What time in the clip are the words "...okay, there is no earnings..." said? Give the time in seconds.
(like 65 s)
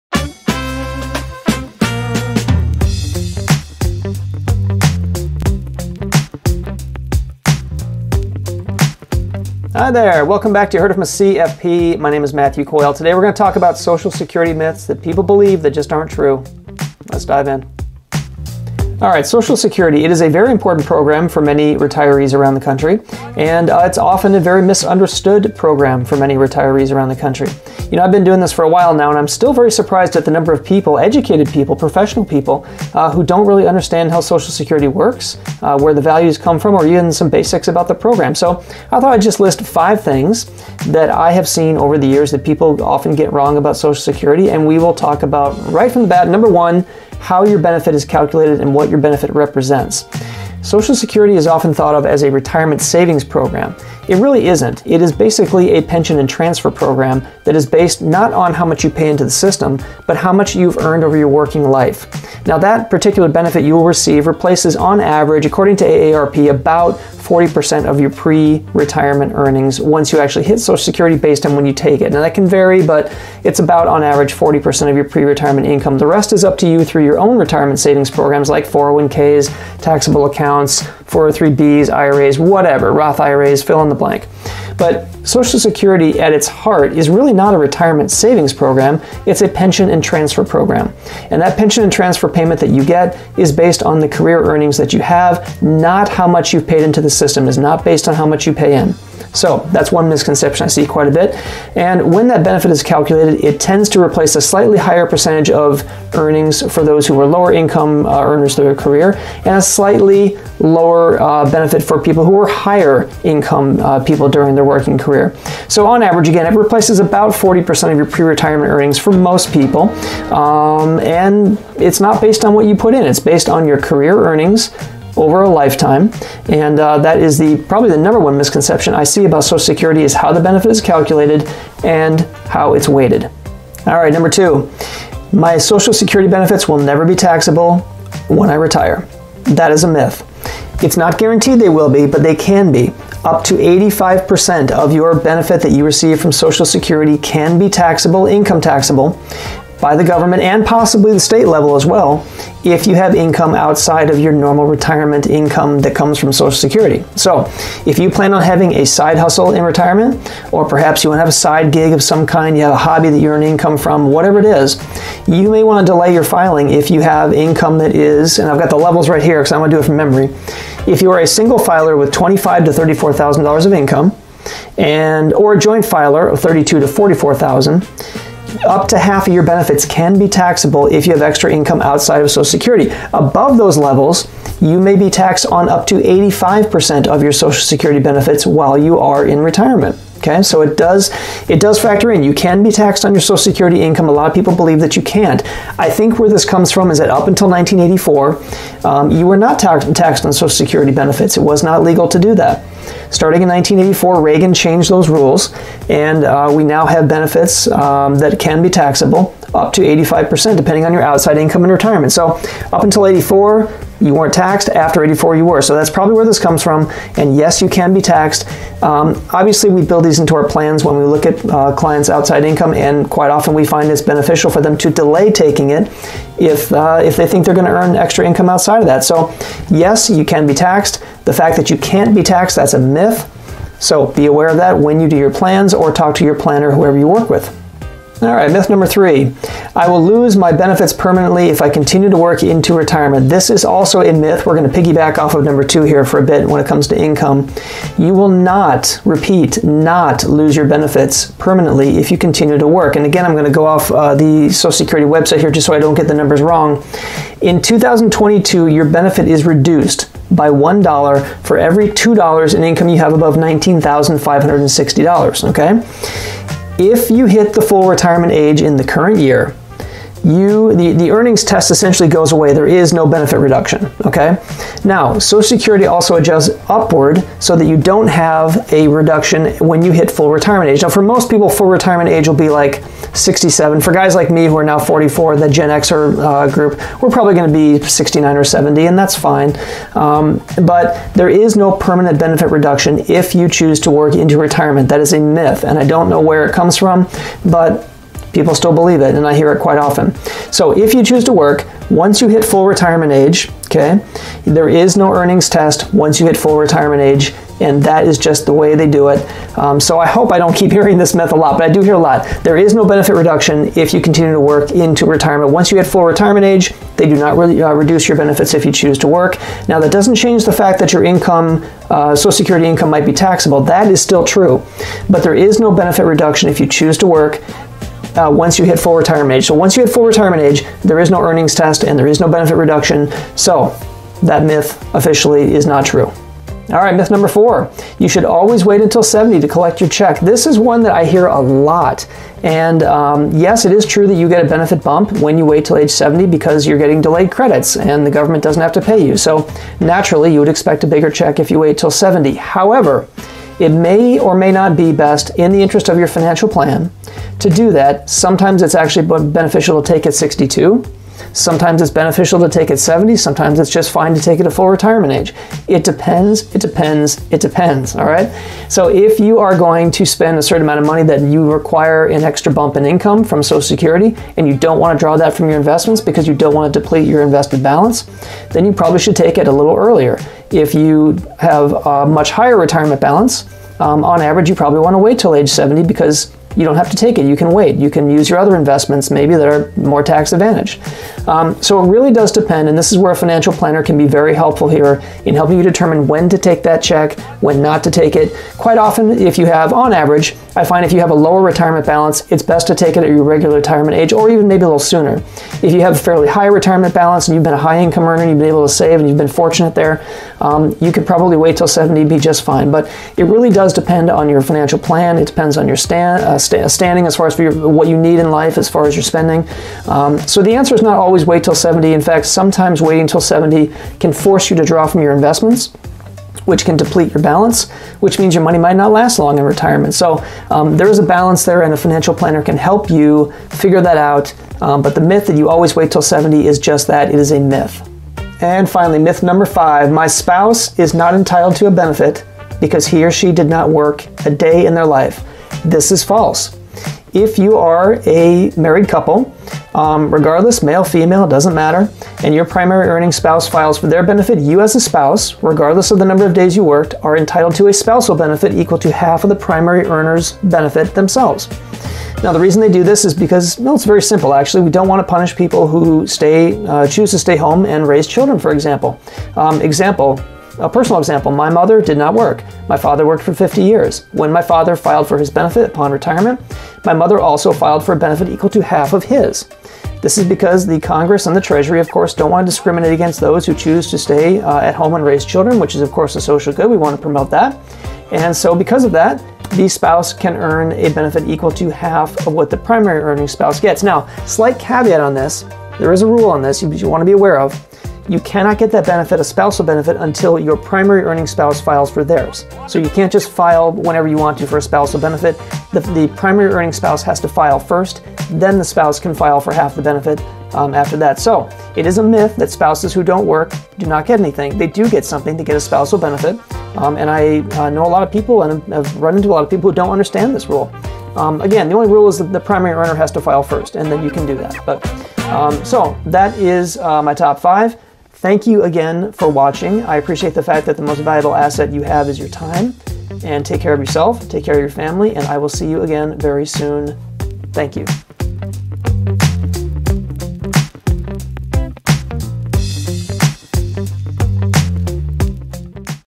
303 s.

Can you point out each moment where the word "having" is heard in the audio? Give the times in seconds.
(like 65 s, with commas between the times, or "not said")
158 s.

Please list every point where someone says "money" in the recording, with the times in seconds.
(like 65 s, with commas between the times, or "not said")
370 s, 428 s.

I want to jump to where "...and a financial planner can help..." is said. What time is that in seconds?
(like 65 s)
431 s.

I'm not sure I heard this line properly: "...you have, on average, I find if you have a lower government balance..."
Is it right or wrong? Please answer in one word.
wrong.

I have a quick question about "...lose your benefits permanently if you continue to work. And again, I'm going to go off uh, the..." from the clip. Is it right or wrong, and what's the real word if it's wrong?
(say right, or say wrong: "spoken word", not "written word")
right.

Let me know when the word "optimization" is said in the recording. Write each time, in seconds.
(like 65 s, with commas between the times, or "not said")
not said.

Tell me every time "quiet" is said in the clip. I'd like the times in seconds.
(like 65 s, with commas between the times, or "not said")
not said.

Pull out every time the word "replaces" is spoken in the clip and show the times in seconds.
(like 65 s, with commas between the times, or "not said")
64 s, 104 s, 116 s.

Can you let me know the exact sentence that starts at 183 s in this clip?
Above those levels, you may be taxed on up to 85% of your Social Security benefits while you are in retirement.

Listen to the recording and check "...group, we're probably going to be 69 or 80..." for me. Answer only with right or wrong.
wrong.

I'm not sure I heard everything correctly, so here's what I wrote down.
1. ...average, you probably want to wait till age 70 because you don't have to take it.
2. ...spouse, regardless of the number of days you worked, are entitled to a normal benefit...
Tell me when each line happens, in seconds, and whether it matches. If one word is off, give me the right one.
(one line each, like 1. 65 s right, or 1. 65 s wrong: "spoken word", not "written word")
1. 384 s right
2. 454 s wrong: "spousal", not "normal".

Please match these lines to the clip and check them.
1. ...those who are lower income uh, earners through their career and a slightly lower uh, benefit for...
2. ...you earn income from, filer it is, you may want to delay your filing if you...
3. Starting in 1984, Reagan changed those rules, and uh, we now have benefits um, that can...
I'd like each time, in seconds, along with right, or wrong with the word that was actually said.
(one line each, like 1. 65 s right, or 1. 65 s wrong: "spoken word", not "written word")
1. 106 s right
2. 163 s wrong: "whatever", not "filer"
3. 203 s right.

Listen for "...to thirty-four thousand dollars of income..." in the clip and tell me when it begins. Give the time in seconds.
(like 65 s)
172 s.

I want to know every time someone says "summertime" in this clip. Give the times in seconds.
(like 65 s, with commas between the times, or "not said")
not said.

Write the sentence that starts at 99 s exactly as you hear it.
So that's one misconception I see quite a bit.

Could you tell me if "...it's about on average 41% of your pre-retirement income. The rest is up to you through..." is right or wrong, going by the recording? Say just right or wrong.
wrong.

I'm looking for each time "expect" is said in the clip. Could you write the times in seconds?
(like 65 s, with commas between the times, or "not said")
350 s.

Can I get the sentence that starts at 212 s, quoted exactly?
So, up until 84, you weren't taxed.